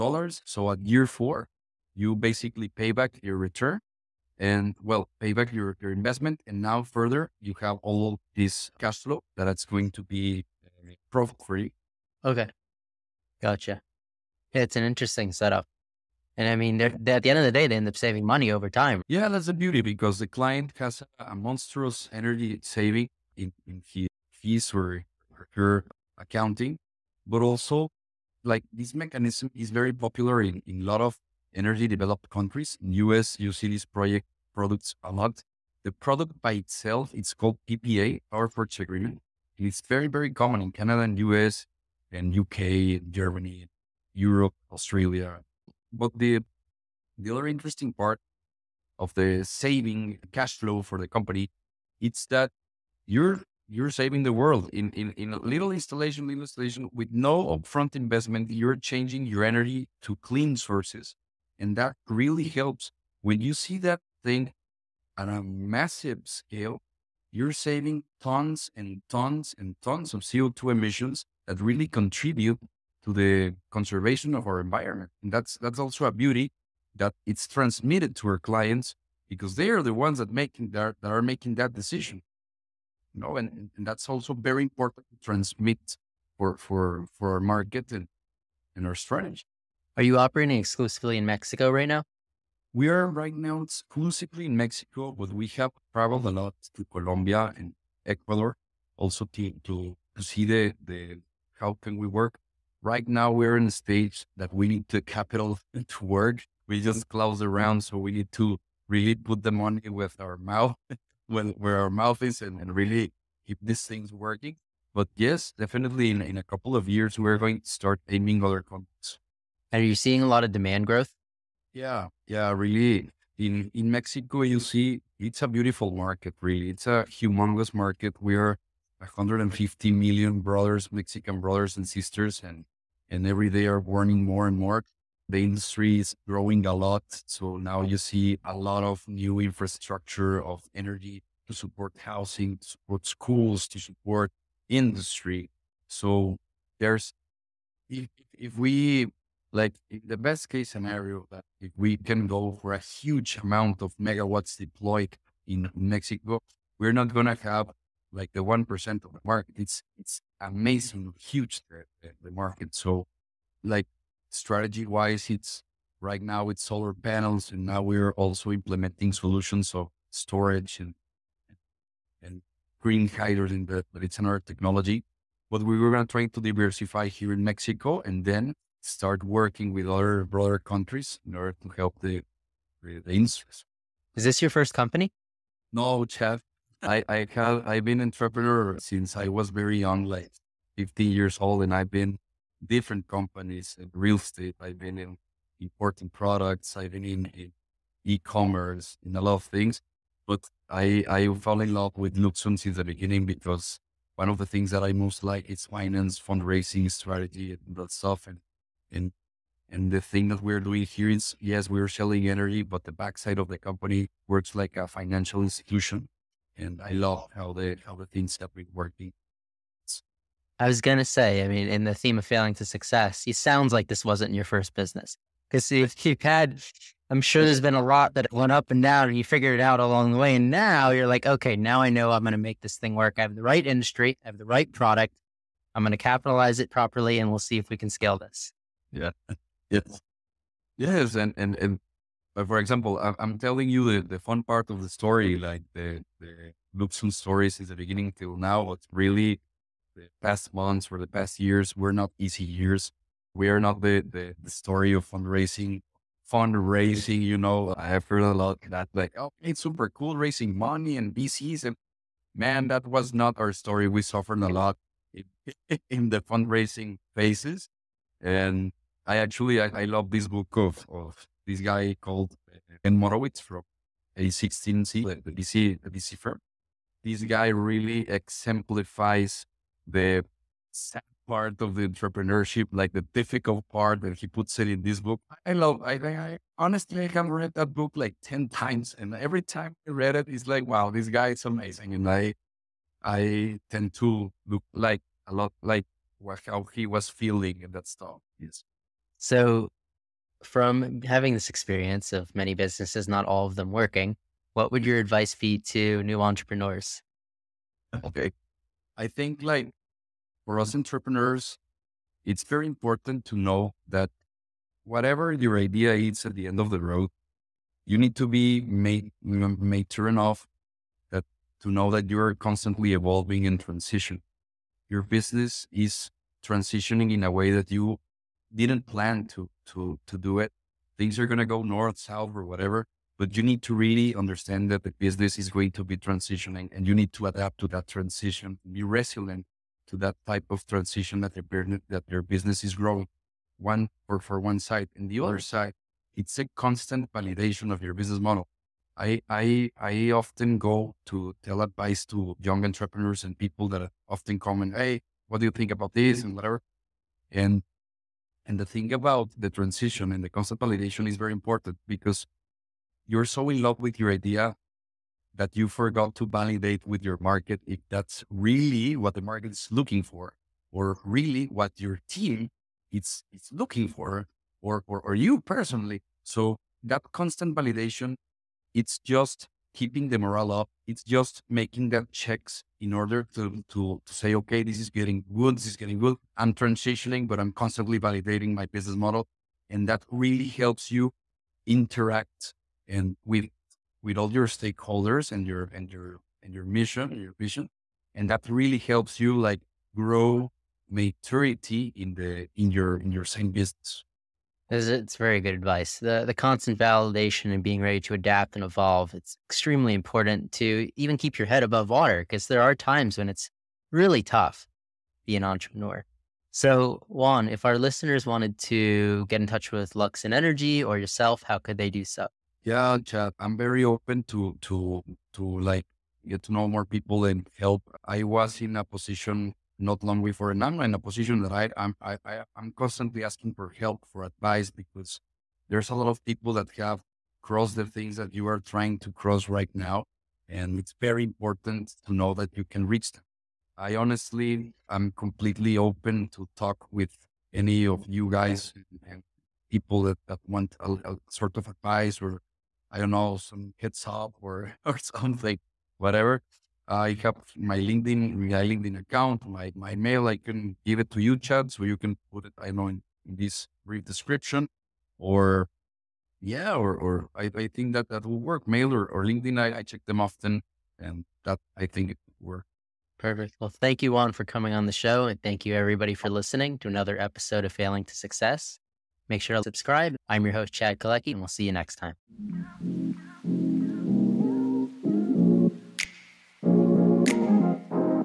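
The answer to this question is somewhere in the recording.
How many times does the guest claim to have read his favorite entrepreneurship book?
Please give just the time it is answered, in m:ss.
4:48.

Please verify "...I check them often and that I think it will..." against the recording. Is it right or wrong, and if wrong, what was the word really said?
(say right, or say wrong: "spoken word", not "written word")
right.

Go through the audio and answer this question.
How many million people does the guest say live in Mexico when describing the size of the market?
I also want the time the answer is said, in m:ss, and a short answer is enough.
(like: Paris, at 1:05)
150 million, at 2:08.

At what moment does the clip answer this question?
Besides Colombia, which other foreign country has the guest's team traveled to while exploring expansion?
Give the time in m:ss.
1:38.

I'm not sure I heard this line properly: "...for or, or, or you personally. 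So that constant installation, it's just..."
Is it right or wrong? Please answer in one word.
wrong.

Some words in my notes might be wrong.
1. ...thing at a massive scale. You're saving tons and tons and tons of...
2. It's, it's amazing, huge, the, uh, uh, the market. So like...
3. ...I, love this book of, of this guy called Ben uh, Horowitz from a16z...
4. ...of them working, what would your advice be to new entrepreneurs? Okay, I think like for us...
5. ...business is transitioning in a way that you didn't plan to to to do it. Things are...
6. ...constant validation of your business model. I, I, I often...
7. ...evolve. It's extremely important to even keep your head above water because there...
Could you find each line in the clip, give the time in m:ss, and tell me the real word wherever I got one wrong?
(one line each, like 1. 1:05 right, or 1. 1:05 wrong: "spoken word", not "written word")
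1. 1:04 right
2. 2:39 right
3. 4:29 right
4. 5:03 right
5. 5:25 right
6. 5:46 right
7. 6:48 right.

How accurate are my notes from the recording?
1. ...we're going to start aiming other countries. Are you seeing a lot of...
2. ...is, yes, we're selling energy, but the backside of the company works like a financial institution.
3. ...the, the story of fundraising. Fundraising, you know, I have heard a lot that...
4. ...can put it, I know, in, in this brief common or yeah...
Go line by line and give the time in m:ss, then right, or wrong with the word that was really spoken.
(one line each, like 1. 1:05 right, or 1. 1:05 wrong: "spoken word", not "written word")
1. 1:57 right
2. 3:31 right
3. 4:14 right
4. 7:41 wrong: "description", not "common".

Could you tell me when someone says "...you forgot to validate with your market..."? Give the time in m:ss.
6:05.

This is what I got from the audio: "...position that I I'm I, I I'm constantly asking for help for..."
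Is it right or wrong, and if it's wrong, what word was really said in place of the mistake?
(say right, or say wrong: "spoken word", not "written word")
right.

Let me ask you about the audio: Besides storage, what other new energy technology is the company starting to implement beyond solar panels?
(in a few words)
Green hydrogen.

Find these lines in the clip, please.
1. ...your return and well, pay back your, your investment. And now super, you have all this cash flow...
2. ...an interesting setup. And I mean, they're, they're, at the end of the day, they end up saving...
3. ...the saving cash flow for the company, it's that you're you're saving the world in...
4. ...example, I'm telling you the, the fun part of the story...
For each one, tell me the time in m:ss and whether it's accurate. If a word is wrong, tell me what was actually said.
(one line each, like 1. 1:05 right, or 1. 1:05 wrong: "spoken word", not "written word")
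1. 0:03 wrong: "further", not "super"
2. 0:14 right
3. 0:49 right
4. 4:02 right.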